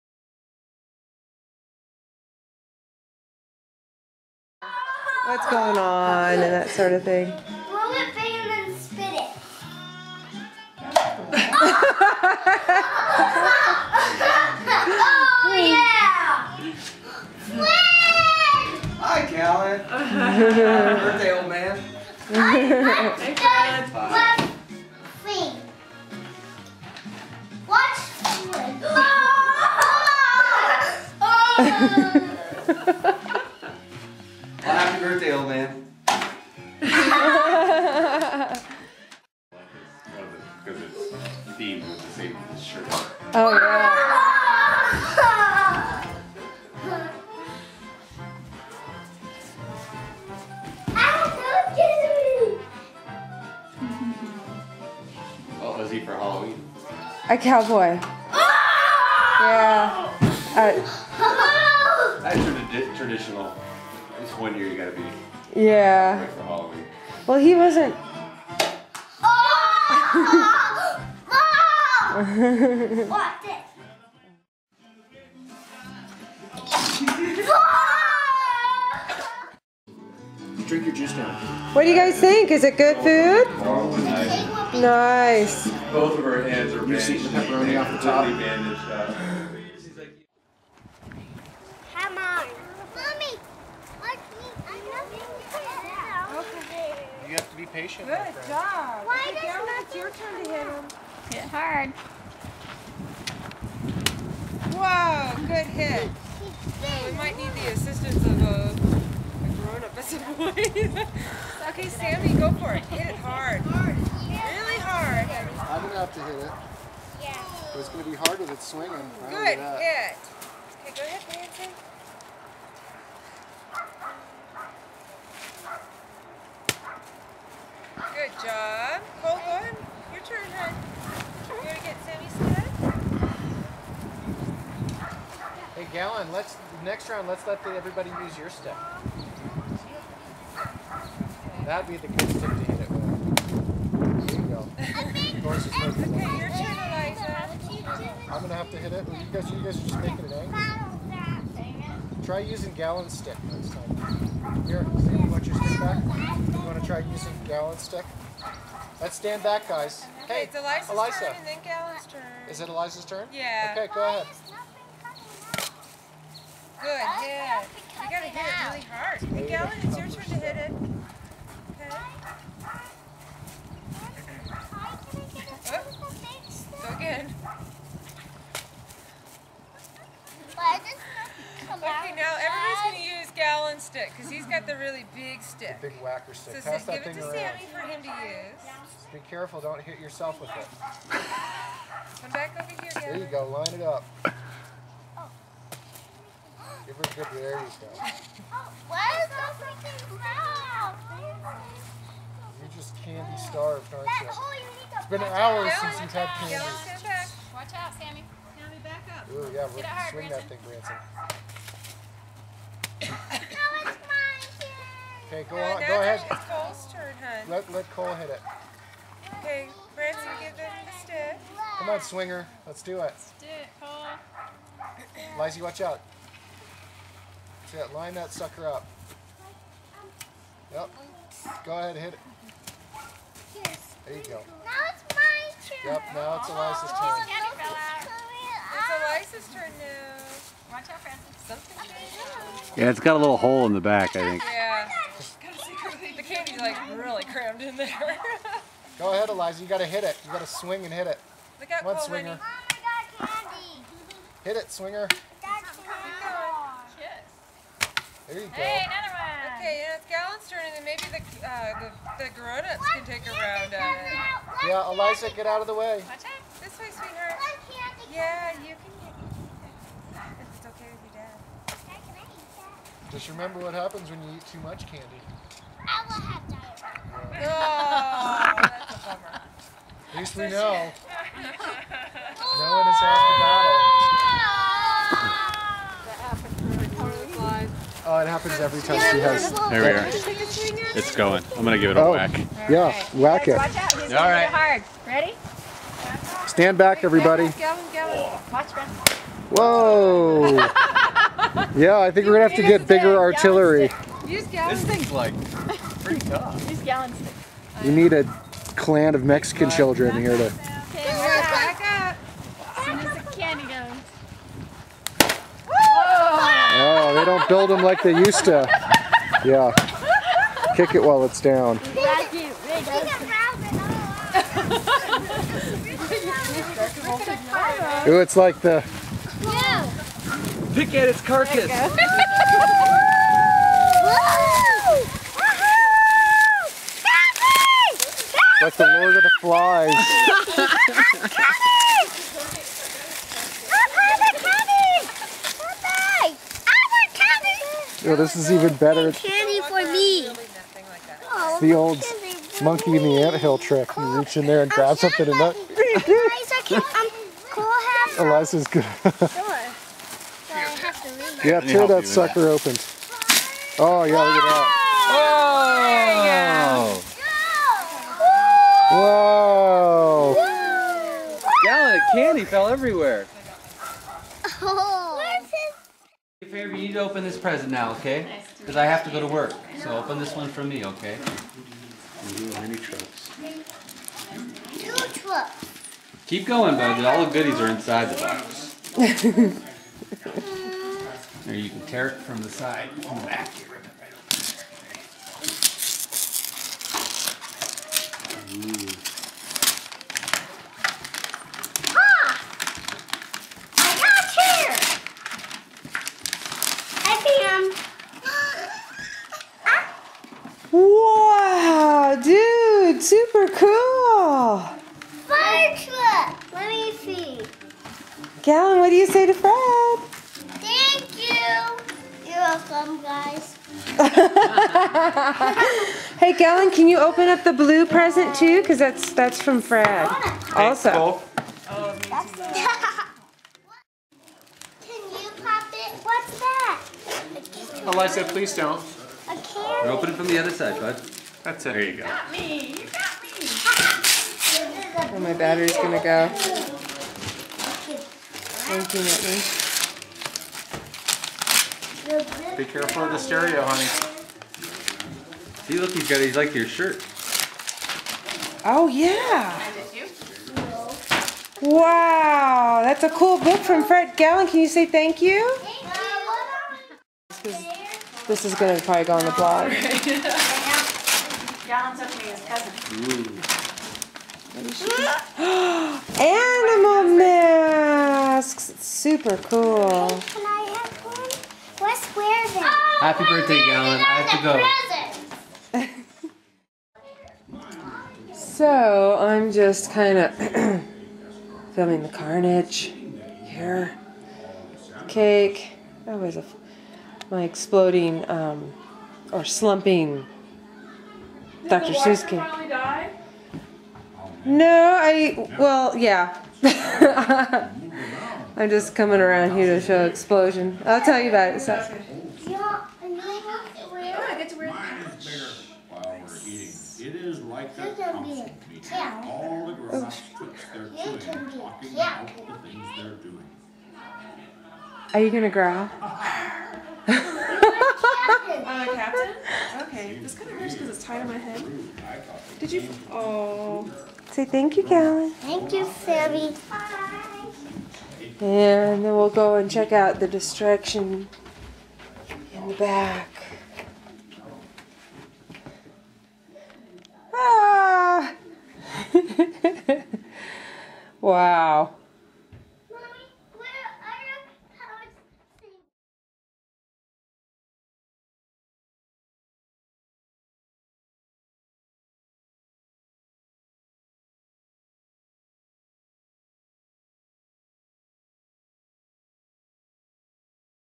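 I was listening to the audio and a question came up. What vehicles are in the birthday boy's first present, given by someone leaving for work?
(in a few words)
Mini trucks.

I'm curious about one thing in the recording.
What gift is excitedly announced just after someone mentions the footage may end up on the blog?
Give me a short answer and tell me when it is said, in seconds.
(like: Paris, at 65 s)
Animal masks, at 476 s.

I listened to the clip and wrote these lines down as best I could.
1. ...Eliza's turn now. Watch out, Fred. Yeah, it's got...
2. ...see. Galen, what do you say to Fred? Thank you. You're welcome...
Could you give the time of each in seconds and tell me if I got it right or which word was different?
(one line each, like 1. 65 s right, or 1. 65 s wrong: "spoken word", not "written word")
1. 239 s wrong: "Francis", not "Fred"
2. 416 s right.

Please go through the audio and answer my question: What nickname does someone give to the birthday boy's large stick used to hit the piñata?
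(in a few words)
The big whacker stick.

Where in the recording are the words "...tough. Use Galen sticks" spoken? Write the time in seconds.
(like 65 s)
306 s.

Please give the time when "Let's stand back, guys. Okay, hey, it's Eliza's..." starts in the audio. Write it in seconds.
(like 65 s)
159 s.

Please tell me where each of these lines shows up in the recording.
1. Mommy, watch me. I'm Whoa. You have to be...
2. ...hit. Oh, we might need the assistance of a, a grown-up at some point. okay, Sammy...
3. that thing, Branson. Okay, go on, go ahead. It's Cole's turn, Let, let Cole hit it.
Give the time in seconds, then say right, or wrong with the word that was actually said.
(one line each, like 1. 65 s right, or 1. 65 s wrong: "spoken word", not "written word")
1. 92 s wrong: "Okay", not "Whoa"
2. 105 s right
3. 210 s right.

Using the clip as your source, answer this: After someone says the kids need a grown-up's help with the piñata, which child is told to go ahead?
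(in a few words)
Nancy.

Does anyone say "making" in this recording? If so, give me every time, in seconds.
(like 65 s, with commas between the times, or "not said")
150 s.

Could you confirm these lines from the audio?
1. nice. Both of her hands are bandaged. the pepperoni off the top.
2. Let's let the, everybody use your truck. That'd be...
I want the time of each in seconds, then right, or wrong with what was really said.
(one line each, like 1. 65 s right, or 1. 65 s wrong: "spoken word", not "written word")
1. 84 s right
2. 137 s wrong: "stick", not "truck".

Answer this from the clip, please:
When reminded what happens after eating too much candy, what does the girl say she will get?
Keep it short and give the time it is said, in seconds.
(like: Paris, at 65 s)
Diarrhea, at 276 s.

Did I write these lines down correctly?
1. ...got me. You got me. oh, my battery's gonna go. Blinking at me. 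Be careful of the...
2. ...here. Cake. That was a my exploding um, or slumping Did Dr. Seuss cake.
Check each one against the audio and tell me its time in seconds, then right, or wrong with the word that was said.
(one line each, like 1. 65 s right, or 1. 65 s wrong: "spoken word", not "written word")
1. 442 s right
2. 493 s right.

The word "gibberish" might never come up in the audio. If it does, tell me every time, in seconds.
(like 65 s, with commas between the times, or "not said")
not said.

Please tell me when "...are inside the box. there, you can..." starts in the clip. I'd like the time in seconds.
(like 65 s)
387 s.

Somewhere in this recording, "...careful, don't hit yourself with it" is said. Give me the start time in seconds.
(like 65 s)
189 s.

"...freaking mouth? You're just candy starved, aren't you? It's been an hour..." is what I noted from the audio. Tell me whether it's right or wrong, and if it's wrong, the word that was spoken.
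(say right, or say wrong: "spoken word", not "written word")
right.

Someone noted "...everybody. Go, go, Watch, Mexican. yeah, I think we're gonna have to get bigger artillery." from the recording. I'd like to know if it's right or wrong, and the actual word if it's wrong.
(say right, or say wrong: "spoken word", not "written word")
wrong: "Whoa", not "Mexican".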